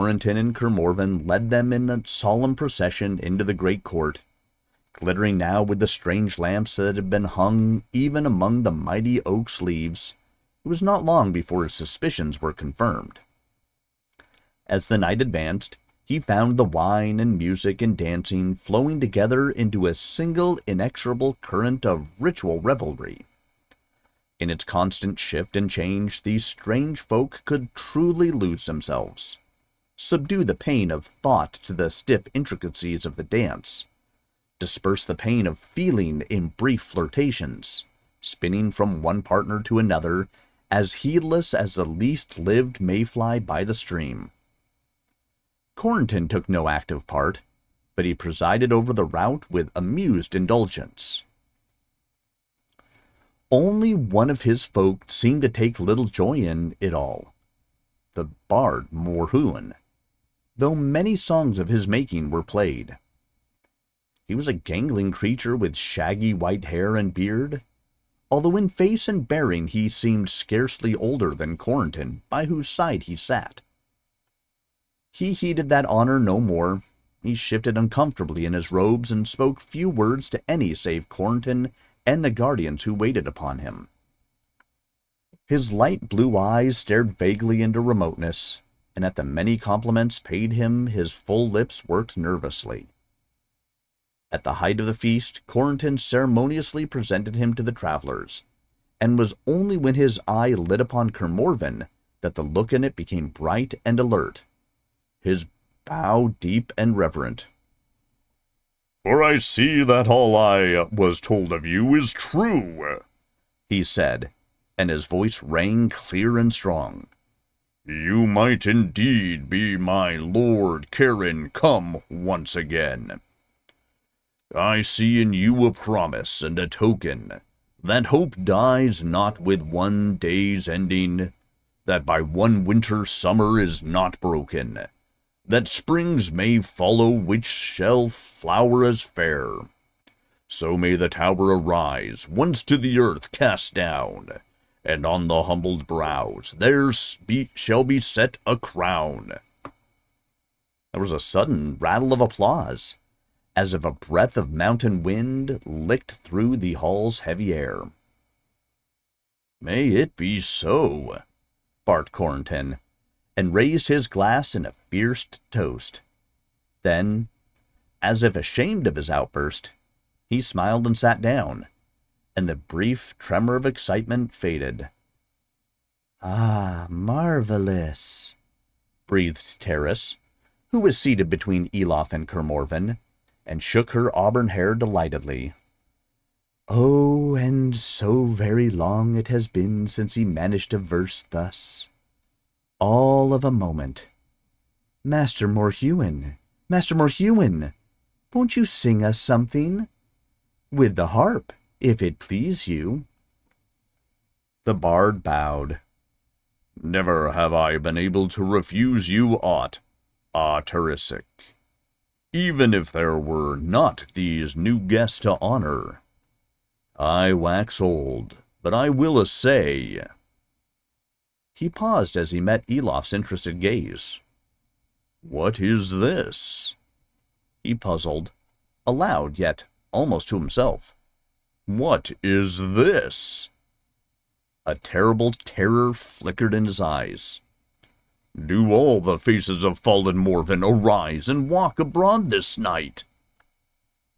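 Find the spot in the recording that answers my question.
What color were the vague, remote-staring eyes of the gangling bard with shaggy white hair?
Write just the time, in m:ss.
1:25.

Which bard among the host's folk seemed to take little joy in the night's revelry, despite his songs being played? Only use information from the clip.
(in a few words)
Morhuan.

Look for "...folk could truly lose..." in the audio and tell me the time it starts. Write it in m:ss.
0:26.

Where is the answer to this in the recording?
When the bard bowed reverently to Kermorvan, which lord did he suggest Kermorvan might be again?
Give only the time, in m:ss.
2:00.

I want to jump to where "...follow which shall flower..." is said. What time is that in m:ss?
2:16.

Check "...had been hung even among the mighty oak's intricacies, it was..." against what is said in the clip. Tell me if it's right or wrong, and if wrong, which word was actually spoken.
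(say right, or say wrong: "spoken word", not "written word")
wrong: "leaves", not "intricacies".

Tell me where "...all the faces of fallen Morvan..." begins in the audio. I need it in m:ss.
3:58.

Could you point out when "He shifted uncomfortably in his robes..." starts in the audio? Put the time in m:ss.
1:17.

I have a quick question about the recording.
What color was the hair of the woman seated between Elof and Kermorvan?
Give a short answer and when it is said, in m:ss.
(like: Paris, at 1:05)
Auburn, at 3:04.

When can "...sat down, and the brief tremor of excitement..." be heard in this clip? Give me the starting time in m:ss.
2:50.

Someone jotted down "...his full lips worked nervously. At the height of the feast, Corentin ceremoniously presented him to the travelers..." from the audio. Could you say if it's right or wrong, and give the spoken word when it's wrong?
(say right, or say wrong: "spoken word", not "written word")
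right.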